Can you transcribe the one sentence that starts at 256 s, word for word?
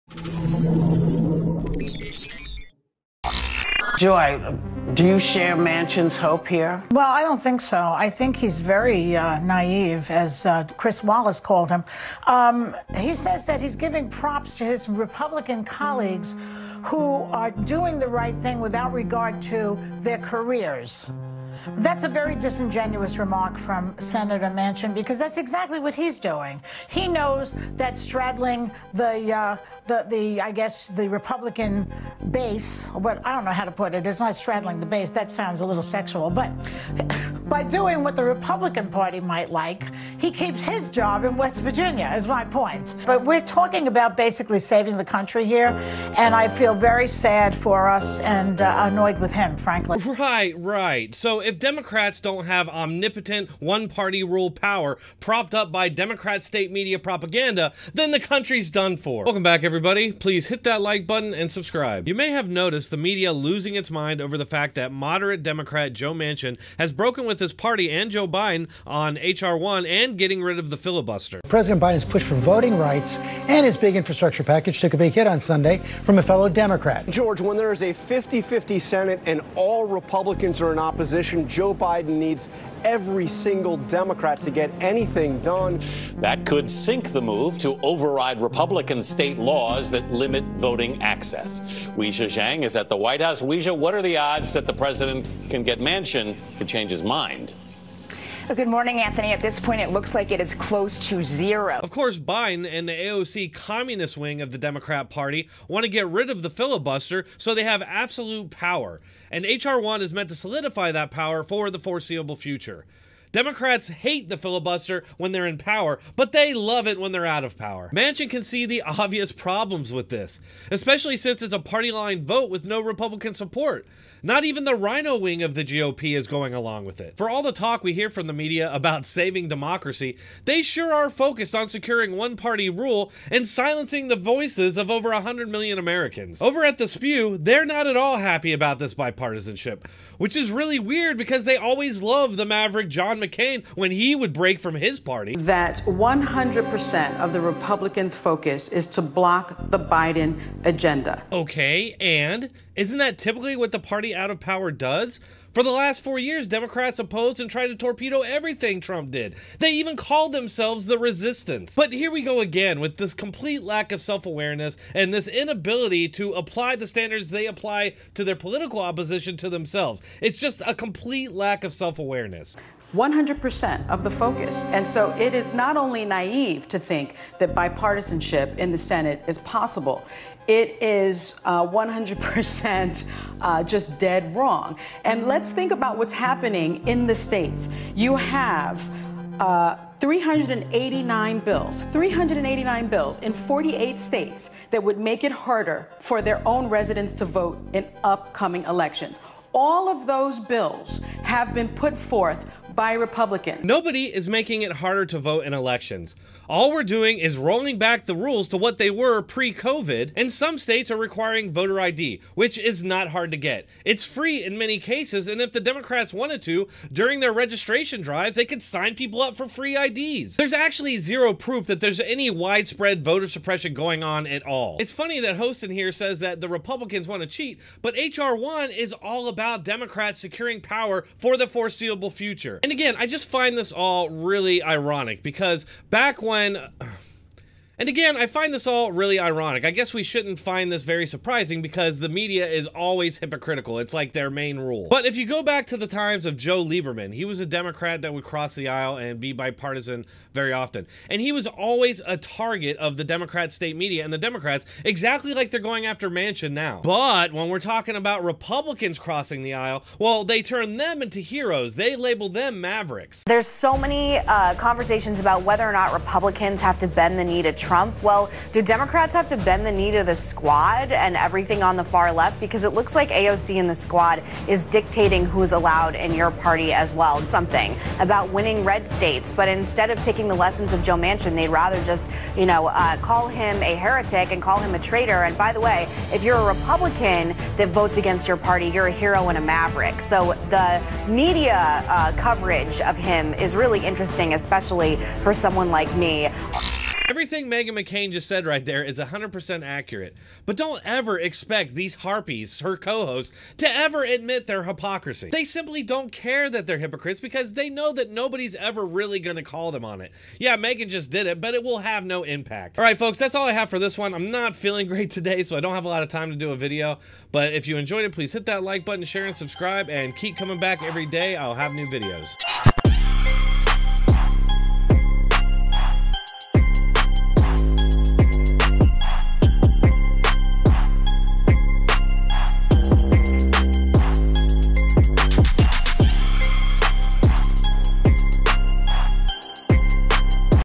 But when we're talking about Republicans crossing the aisle, well, they turn them into heroes.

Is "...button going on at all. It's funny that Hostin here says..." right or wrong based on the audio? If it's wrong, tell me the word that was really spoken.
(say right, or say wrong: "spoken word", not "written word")
wrong: "suppression", not "button".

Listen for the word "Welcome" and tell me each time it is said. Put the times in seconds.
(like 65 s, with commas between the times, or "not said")
59 s.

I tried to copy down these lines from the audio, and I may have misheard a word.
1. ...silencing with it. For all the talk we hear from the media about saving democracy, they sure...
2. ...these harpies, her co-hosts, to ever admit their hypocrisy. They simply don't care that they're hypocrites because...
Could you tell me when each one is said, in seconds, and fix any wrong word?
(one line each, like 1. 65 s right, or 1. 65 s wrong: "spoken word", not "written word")
1. 126 s wrong: "along", not "silencing"
2. 301 s right.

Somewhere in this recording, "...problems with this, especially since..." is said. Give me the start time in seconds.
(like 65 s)
119 s.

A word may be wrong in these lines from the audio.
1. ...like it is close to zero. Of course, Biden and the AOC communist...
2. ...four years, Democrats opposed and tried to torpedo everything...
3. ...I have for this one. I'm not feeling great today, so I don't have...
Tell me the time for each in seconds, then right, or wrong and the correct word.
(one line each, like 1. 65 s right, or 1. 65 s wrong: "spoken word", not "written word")
1. 100 s right
2. 156 s right
3. 313 s right.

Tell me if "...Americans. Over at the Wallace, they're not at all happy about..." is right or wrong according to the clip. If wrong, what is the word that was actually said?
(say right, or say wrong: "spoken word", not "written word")
wrong: "Spew", not "Wallace".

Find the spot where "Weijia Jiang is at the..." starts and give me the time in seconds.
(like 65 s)
91 s.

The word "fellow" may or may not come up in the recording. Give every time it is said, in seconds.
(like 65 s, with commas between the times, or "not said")
76 s.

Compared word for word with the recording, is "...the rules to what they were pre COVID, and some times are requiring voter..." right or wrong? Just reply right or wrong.
wrong.